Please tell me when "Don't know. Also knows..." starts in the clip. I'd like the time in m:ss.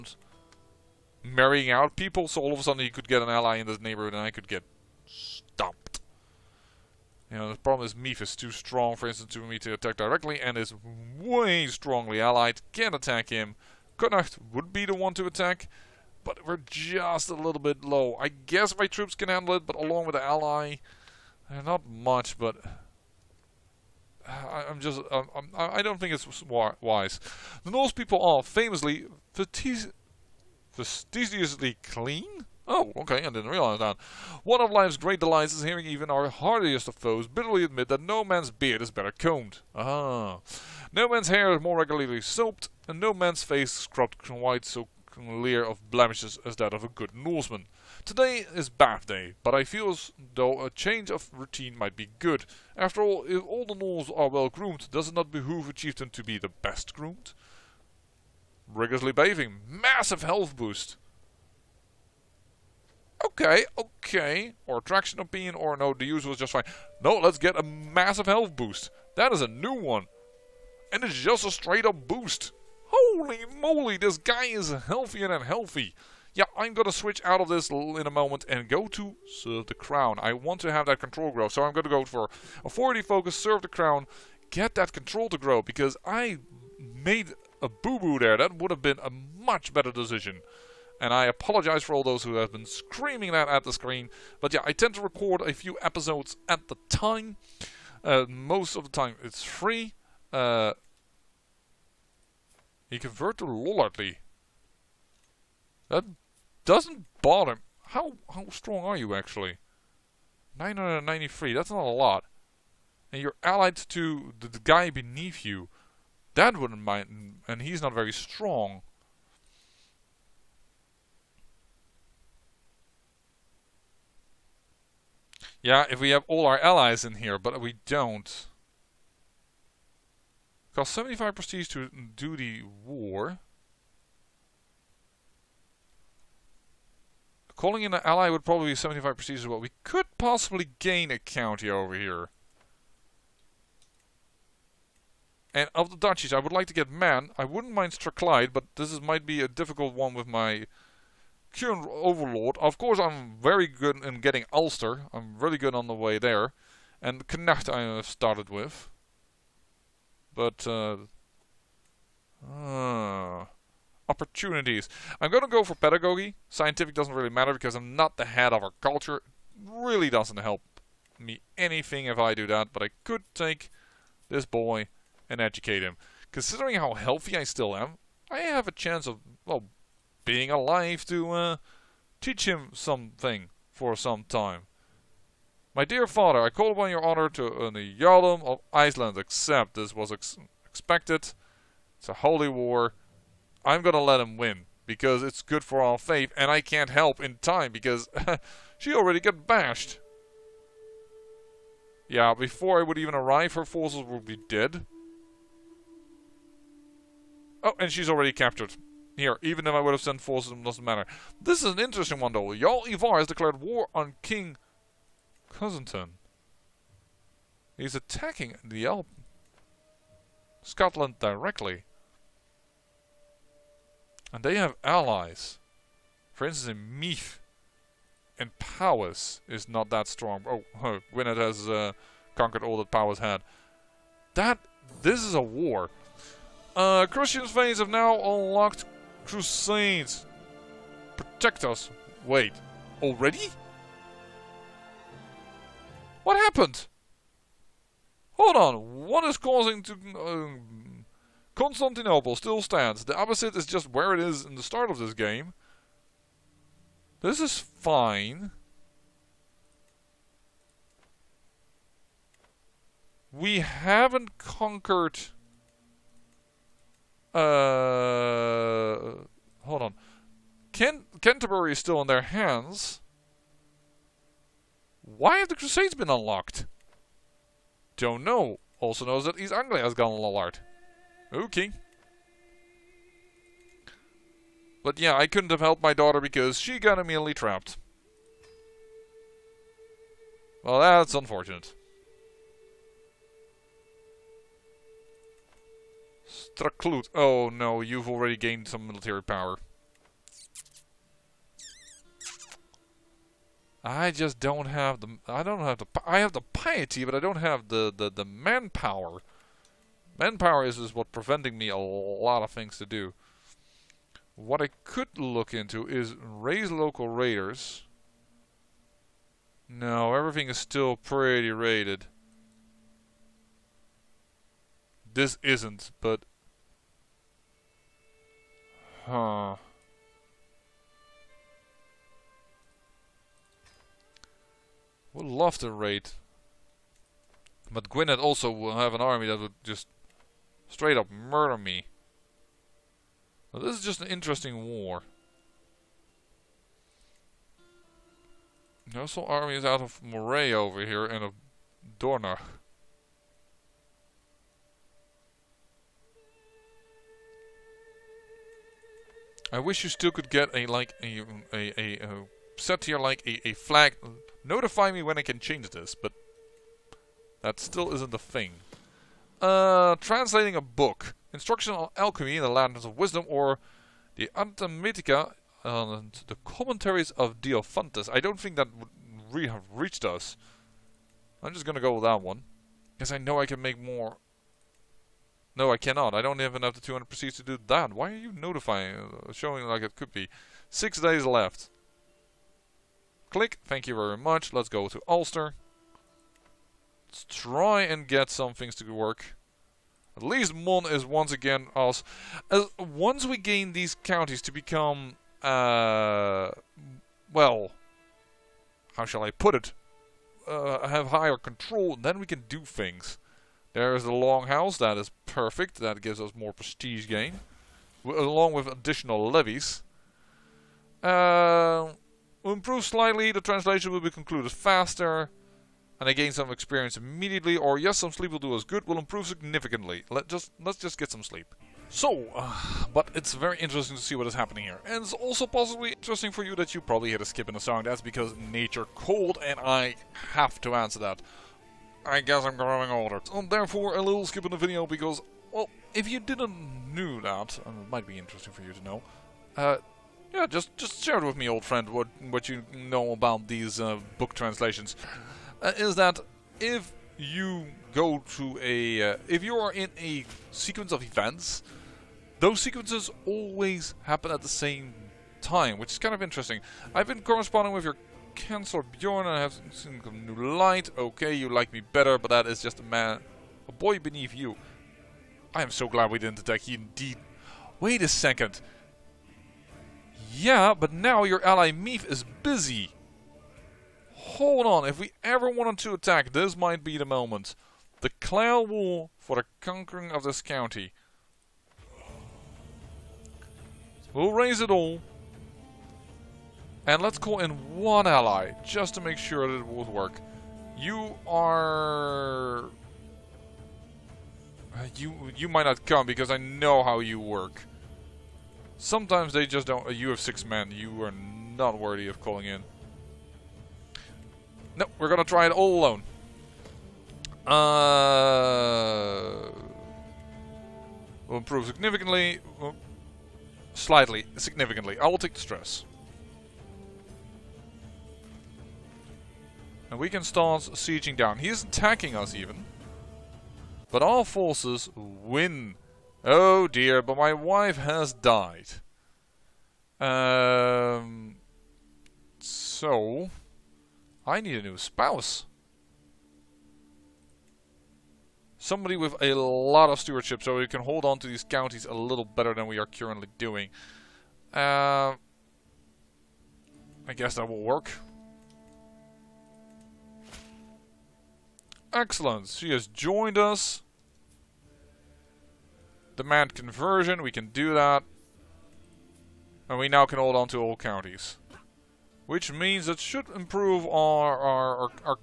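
4:37.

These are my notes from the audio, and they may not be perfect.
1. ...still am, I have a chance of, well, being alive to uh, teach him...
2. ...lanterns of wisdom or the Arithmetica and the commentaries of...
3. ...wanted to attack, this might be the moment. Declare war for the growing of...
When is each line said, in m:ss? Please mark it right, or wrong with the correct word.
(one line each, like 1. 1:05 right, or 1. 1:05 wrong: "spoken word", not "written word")
1. 2:57 right
2. 6:12 right
3. 8:05 wrong: "conquering", not "growing".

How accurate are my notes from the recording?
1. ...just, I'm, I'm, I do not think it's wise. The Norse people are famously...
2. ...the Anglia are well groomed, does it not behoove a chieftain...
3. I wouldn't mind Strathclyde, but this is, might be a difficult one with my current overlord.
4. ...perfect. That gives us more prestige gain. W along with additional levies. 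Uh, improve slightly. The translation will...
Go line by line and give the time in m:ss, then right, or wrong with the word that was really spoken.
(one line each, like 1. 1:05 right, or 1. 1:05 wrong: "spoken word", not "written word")
1. 0:24 right
2. 0:53 wrong: "Norse", not "Anglia"
3. 2:27 right
4. 6:55 right.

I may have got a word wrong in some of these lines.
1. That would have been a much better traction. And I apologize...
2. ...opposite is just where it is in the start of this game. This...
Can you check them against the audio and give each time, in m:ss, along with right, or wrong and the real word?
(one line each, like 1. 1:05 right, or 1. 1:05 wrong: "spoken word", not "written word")
1. 1:28 wrong: "decision", not "traction"
2. 4:13 right.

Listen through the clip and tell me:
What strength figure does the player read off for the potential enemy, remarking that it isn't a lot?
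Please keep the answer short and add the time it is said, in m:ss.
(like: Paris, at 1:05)
993, at 1:50.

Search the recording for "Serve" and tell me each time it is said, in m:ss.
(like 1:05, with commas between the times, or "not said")
1:19, 1:23.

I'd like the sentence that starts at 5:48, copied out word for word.
Nossel army is out of Moray over here and of Dornach.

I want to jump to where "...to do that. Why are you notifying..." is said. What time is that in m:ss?
6:27.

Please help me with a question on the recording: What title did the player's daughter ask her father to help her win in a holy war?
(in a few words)
Jarldom of Iceland.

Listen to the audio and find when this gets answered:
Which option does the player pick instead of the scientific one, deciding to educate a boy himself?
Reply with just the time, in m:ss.
2:45.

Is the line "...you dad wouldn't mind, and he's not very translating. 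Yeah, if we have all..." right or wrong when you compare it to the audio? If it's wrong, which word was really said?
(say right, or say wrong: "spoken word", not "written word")
wrong: "strong", not "translating".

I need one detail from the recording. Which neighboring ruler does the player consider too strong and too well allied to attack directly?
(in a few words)
Mephisto.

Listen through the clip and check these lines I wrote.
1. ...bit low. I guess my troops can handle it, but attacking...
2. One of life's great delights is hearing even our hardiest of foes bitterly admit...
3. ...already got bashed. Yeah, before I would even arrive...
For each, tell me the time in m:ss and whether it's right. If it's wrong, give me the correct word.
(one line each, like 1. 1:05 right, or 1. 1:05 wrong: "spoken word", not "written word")
1. 0:17 wrong: "along", not "attacking"
2. 0:34 right
3. 3:18 right.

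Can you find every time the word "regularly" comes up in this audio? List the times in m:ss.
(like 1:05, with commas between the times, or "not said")
0:41.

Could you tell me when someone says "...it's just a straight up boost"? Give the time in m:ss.
1:11.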